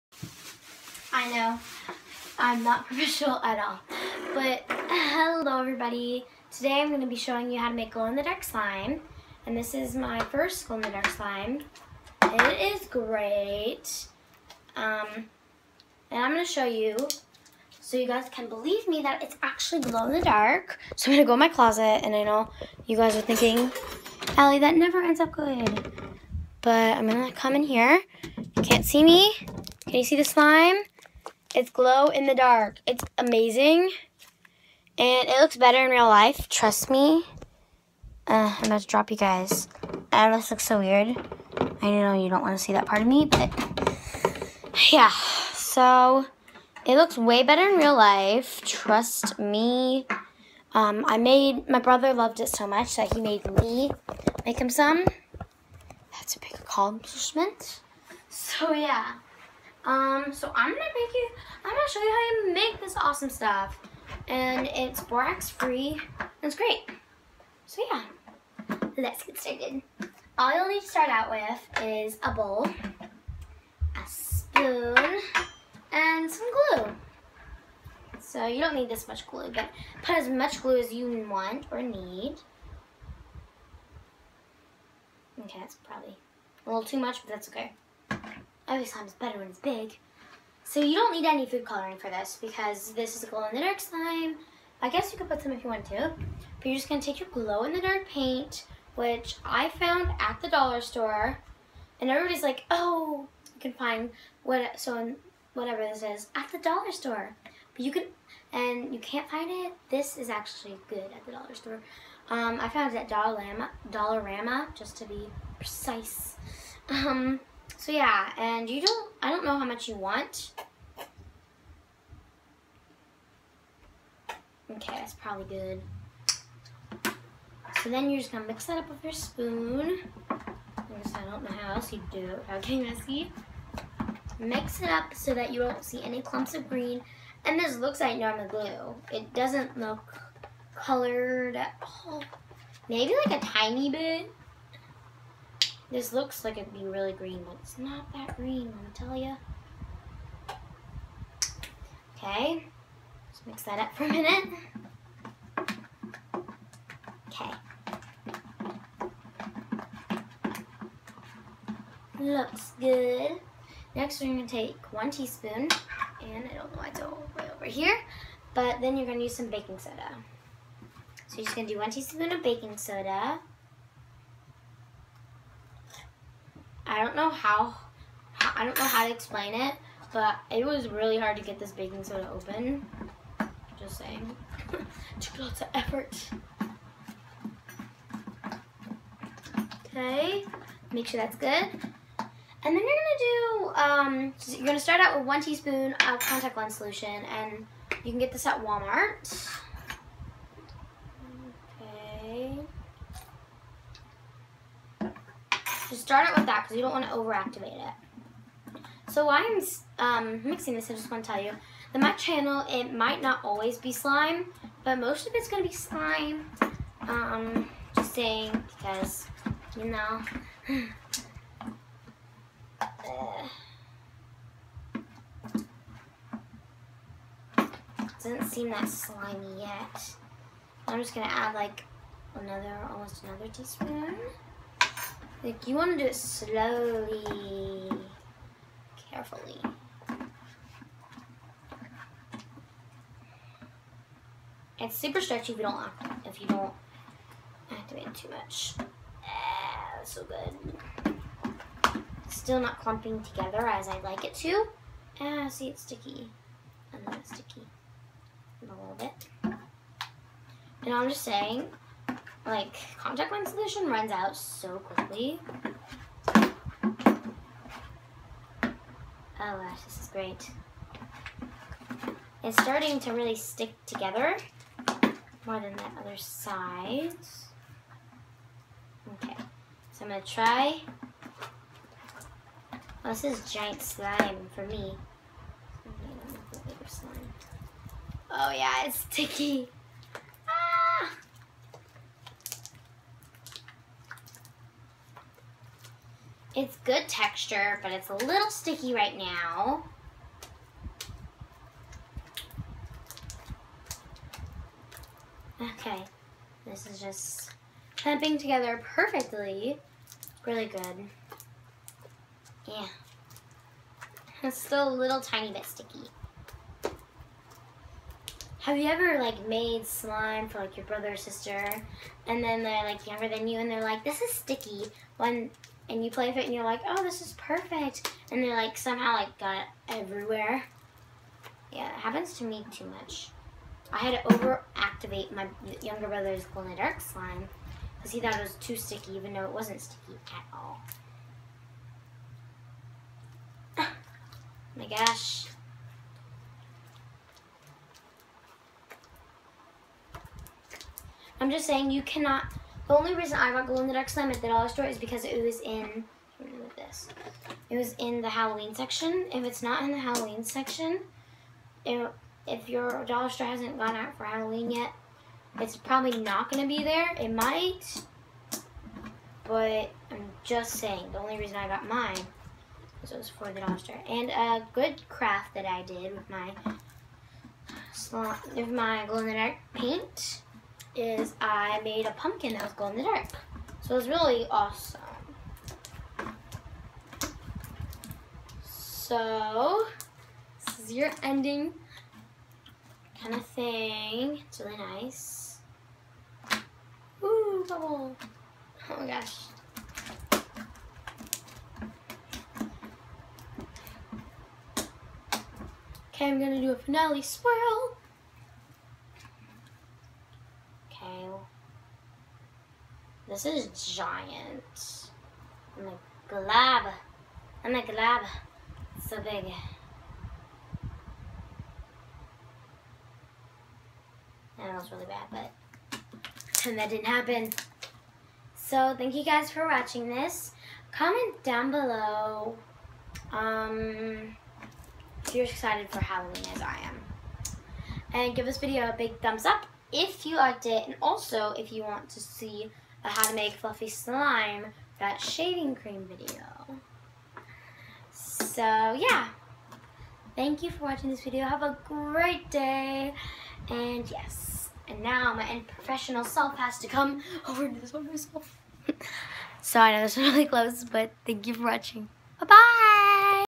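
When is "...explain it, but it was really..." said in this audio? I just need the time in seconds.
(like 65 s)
179 s.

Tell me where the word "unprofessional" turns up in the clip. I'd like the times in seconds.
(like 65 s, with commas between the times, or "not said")
455 s.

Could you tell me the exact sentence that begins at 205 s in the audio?
Just start it with that because you don't want to overactivate it.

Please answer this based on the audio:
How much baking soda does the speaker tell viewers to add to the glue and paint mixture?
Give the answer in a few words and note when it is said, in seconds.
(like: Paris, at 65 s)
1 teaspoon, at 171 s.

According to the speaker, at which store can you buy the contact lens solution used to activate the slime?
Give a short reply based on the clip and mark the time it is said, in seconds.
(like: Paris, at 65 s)
Walmart, at 198 s.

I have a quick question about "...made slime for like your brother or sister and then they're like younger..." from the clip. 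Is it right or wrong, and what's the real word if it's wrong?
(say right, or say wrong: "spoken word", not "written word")
right.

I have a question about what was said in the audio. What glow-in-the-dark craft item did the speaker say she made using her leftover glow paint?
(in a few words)
A pumpkin.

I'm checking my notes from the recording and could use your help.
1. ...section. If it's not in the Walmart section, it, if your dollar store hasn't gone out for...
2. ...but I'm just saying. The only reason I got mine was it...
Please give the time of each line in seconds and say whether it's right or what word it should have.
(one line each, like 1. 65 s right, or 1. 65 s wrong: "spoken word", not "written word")
1. 358 s wrong: "Halloween", not "Walmart"
2. 369 s right.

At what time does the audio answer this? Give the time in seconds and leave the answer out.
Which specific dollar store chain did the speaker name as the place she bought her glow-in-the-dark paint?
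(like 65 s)
113 s.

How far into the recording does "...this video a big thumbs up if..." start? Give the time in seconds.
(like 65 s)
438 s.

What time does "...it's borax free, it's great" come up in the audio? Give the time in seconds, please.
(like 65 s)
64 s.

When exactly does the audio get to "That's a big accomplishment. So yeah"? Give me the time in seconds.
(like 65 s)
56 s.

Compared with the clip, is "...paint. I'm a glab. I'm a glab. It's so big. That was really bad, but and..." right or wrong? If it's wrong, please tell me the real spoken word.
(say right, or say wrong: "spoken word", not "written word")
wrong: "giant", not "paint".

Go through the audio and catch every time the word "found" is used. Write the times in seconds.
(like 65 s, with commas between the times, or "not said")
99 s, 112 s.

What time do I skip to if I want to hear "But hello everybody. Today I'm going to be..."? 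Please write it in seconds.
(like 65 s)
4 s.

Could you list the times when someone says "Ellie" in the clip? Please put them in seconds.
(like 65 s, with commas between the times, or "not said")
24 s.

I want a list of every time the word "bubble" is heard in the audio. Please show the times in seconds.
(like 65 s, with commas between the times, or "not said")
397 s.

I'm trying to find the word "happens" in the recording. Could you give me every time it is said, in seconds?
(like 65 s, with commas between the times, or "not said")
331 s, 427 s.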